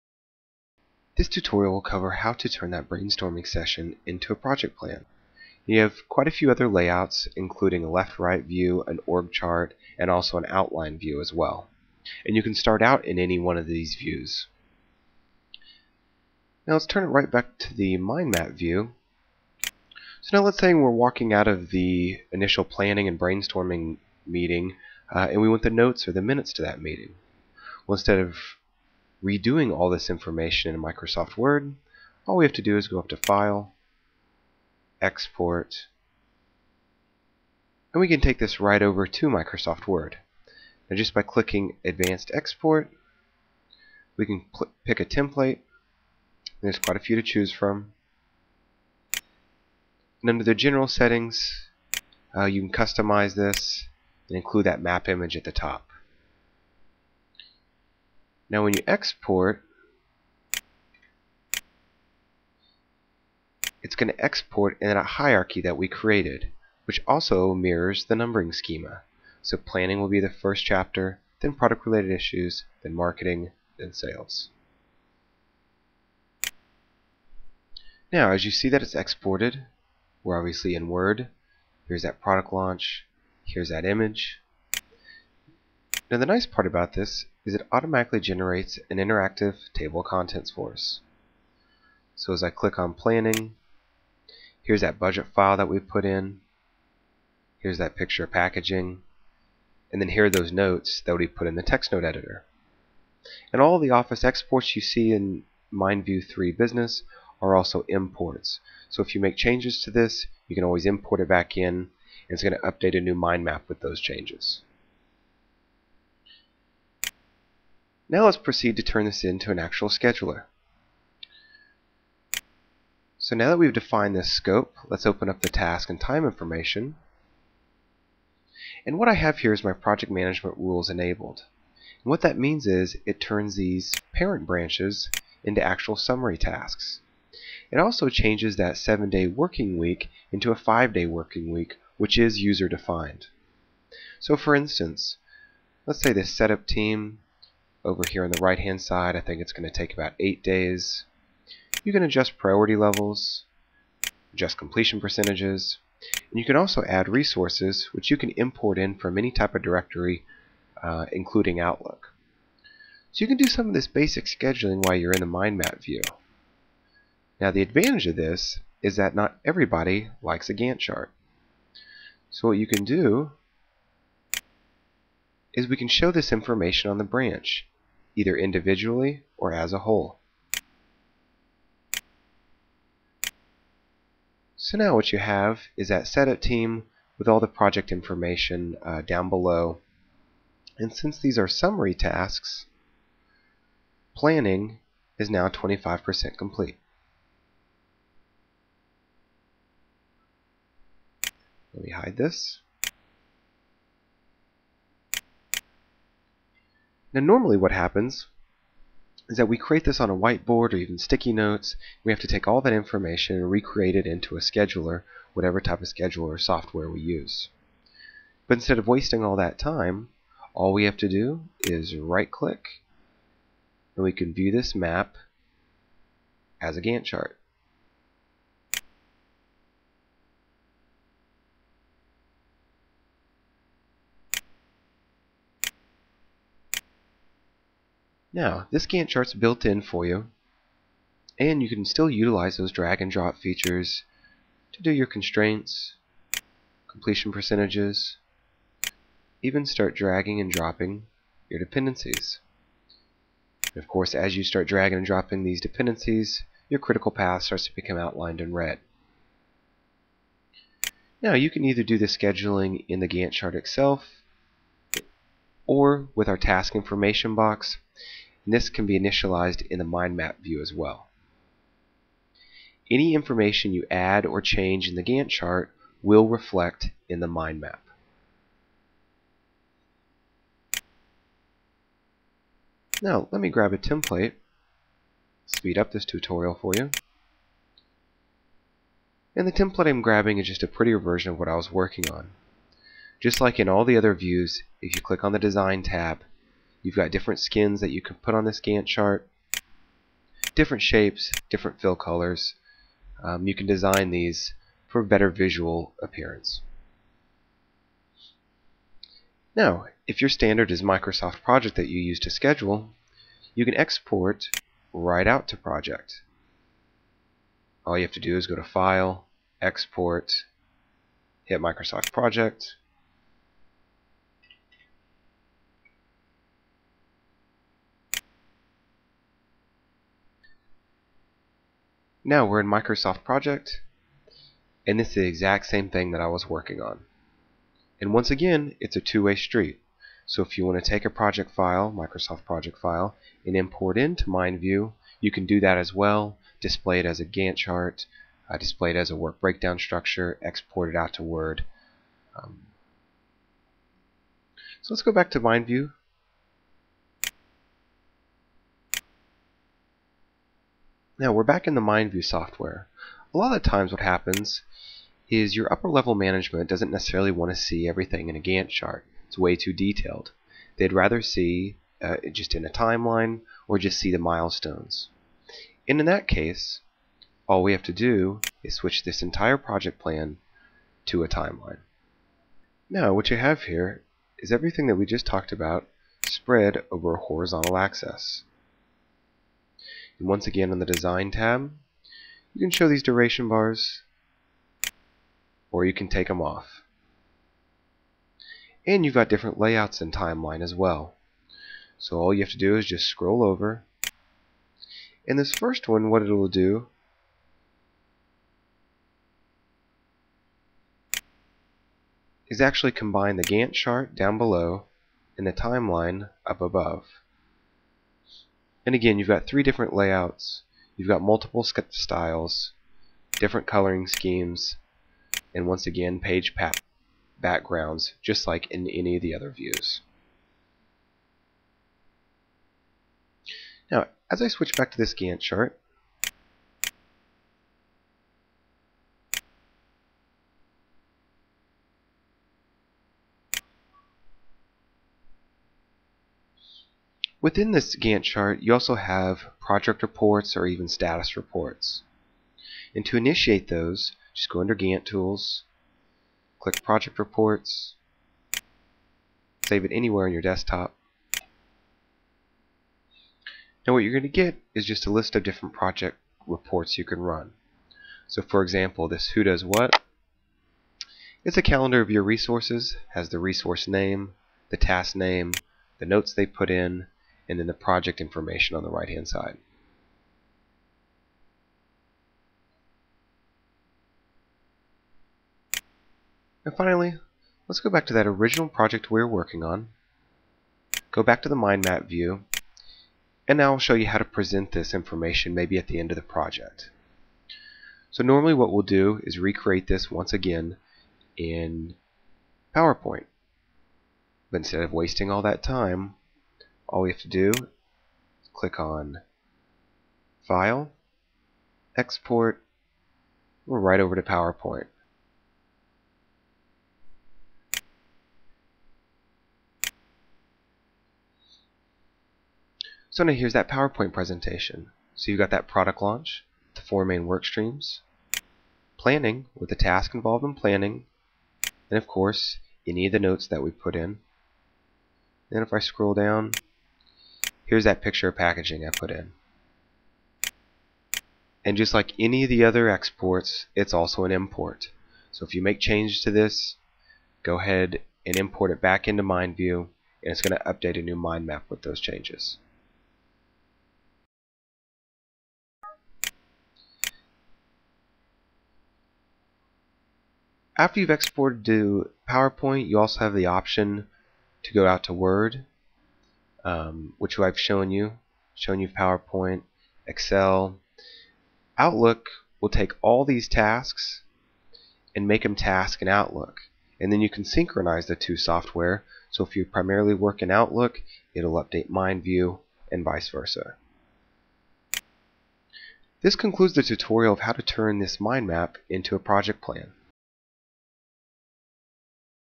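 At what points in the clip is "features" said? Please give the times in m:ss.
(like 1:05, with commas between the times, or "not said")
4:03.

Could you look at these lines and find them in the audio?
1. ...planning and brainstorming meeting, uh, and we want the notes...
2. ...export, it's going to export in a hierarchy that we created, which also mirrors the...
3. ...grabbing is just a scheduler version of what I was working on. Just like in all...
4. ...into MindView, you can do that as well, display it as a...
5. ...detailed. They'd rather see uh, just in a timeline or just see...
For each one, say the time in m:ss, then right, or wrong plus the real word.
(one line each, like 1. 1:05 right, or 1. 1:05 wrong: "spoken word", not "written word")
1. 0:22 right
2. 0:58 right
3. 4:50 wrong: "prettier", not "scheduler"
4. 5:43 right
5. 6:09 right.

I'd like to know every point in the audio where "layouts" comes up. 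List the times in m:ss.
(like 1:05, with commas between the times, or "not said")
0:06, 6:39, 6:59.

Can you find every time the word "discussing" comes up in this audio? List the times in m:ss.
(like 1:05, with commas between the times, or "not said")
not said.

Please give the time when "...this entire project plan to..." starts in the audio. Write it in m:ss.
6:19.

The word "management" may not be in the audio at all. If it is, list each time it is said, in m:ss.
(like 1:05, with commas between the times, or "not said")
2:10, 6:06.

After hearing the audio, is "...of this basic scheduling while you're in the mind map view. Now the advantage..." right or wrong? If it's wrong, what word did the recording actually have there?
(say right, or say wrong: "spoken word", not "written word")
right.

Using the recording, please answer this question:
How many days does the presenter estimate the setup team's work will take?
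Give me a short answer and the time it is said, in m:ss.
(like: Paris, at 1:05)
8, at 2:29.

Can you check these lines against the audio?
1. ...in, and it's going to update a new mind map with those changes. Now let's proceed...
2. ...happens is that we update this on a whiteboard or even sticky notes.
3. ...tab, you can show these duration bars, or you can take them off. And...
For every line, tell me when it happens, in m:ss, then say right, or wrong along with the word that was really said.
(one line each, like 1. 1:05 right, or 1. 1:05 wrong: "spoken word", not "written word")
1. 1:51 right
2. 3:27 wrong: "create", not "update"
3. 6:31 right.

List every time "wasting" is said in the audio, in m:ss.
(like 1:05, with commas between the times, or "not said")
3:38, 8:24.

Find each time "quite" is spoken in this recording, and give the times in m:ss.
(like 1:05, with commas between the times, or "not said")
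0:06, 0:46.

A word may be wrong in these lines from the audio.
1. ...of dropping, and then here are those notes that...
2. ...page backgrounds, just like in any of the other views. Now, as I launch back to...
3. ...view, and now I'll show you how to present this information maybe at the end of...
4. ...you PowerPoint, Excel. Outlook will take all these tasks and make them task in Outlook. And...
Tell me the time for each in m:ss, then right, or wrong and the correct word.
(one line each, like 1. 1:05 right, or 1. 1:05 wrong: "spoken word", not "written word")
1. 1:38 wrong: "packaging", not "dropping"
2. 7:06 wrong: "switch", not "launch"
3. 8:12 right
4. 9:28 right.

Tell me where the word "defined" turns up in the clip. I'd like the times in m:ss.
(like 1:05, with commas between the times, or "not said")
2:03, 2:22.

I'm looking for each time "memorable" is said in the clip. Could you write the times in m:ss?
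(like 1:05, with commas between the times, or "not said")
not said.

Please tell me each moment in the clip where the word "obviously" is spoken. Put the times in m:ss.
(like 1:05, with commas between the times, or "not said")
1:20.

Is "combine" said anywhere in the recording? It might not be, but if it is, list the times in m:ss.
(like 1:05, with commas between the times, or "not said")
6:52.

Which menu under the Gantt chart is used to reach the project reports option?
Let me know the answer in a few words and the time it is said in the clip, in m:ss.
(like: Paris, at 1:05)
Gantt Tools, at 7:34.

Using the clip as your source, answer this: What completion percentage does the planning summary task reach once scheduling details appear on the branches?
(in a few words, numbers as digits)
25%.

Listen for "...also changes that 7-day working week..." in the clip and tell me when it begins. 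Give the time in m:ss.
2:17.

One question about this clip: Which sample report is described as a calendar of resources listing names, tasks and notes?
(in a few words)
Who Does What.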